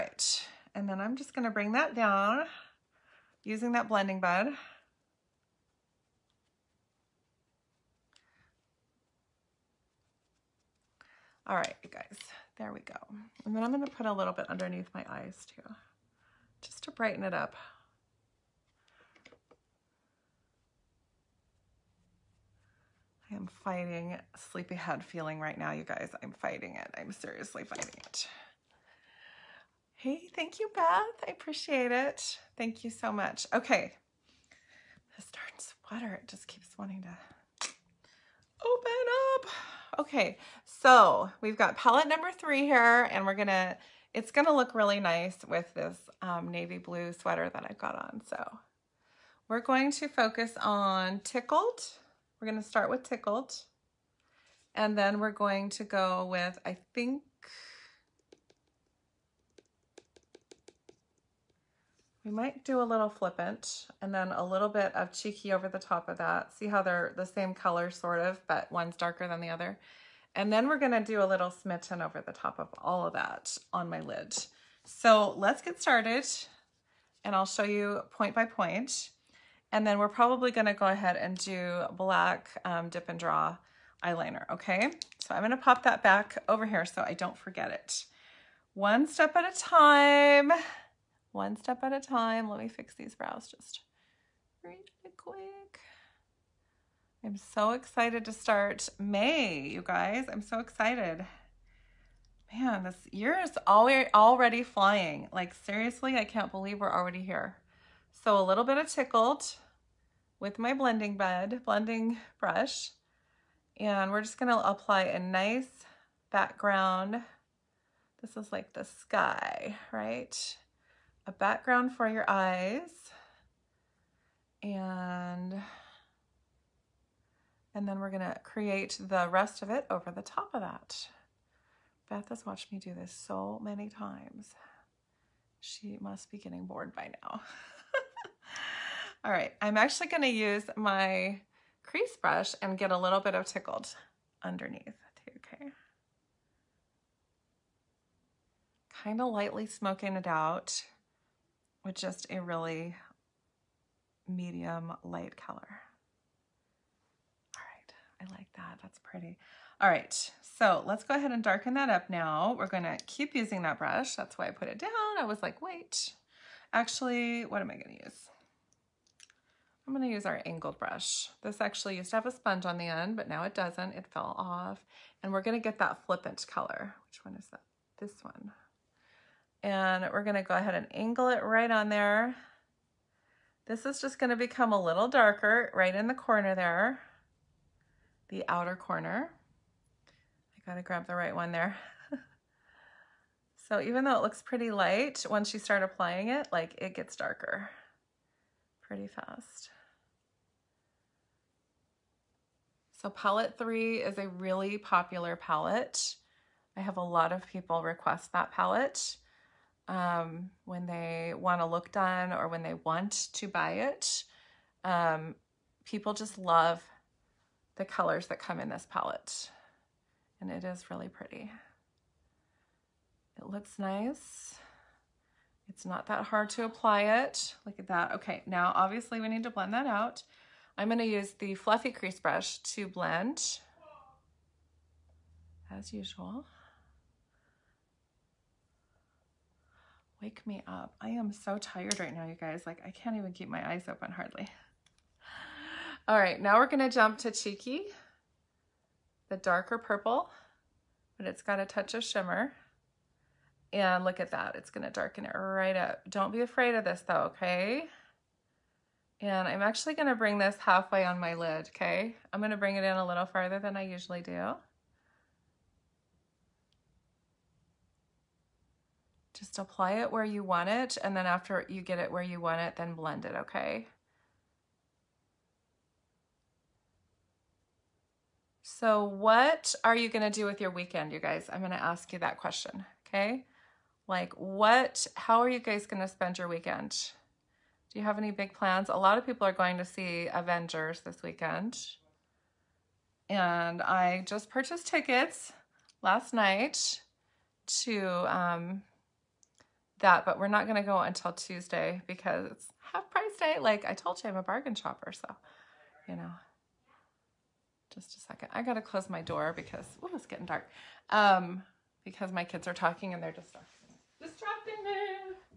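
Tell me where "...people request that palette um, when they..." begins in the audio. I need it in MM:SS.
03:27.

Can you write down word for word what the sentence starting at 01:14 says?
So let's get started and I'll show you point by point.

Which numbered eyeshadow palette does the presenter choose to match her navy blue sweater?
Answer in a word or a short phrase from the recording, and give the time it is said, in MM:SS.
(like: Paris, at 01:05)
3, at 00:41.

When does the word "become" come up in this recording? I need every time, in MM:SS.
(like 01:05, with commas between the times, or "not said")
03:04.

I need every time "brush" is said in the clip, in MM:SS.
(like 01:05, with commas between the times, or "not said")
01:52, 02:22, 02:43, 02:50, 03:52.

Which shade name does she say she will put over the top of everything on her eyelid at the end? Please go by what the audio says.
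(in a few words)
Smitten.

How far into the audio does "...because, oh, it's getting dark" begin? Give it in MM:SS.
05:09.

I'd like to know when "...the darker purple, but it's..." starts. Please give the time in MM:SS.
04:09.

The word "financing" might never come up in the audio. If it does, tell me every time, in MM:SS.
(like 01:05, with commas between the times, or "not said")
not said.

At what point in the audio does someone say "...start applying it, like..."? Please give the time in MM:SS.
03:15.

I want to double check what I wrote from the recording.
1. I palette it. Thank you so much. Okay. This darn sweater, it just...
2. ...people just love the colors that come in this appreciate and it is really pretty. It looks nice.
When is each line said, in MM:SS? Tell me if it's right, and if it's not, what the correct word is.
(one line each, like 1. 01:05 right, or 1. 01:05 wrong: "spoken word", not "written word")
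1. 00:31 wrong: "appreciate", not "palette"
2. 03:35 wrong: "palette", not "appreciate".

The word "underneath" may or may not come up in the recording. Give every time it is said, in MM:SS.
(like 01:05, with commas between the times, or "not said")
00:14, 02:24.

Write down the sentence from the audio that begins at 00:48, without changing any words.
So we're going to focus on Tickled.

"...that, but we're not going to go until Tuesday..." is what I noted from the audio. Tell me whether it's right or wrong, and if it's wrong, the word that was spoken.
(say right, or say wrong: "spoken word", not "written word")
right.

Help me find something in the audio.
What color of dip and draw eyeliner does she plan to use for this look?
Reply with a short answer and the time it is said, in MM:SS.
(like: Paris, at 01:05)
Black, at 01:21.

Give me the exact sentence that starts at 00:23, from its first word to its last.
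I am fighting sleepyhead feeling right now, you guys.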